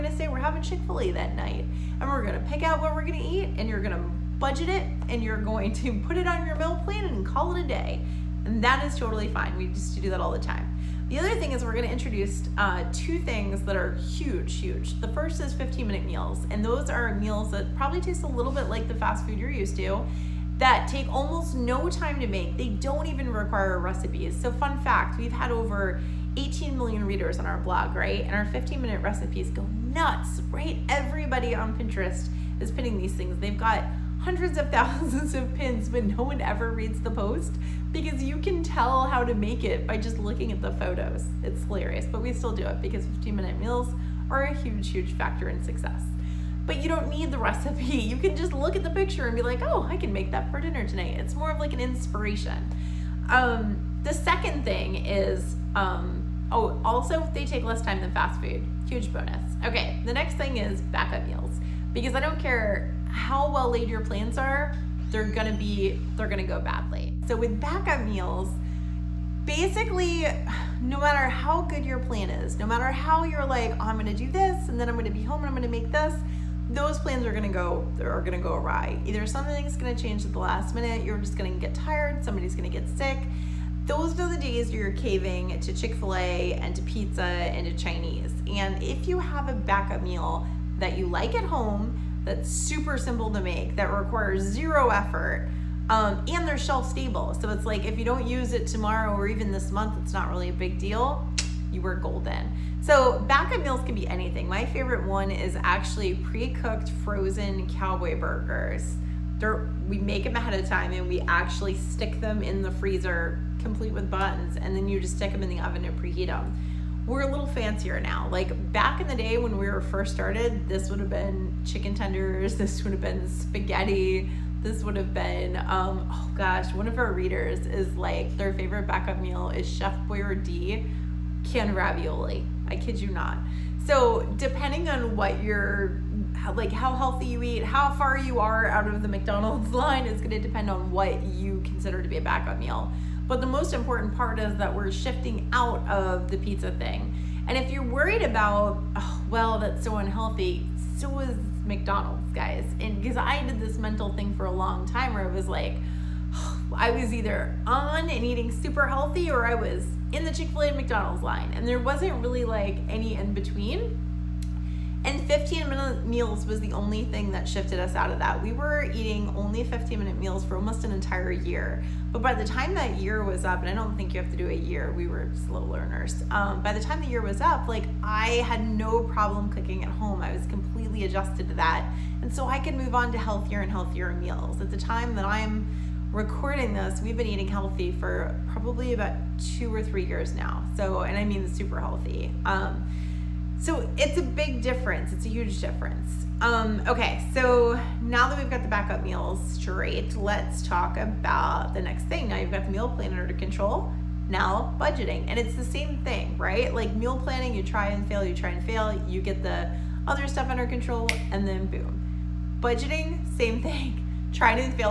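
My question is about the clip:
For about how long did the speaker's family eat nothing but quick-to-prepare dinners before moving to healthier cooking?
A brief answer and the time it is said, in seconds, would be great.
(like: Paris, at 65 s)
almost an entire year, at 170 s.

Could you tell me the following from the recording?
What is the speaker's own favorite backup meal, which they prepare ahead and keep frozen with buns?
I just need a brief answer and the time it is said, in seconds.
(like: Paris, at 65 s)
cowboy burgers, at 107 s.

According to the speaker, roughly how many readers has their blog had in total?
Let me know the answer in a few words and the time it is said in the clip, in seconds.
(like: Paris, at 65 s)
18 million, at 26 s.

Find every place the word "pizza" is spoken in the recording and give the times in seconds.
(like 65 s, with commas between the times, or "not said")
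86 s, 146 s.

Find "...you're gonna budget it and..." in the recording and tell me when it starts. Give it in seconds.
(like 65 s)
3 s.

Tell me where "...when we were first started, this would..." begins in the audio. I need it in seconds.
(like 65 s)
119 s.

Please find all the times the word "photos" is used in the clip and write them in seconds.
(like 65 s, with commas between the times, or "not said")
40 s.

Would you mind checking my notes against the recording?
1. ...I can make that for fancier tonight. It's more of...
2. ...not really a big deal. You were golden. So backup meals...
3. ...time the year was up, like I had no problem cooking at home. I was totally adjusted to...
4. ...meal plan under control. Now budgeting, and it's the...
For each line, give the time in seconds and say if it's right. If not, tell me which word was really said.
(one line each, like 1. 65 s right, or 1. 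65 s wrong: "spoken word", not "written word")
1. 49 s wrong: "dinner", not "fancier"
2. 100 s right
3. 176 s wrong: "completely", not "totally"
4. 202 s right.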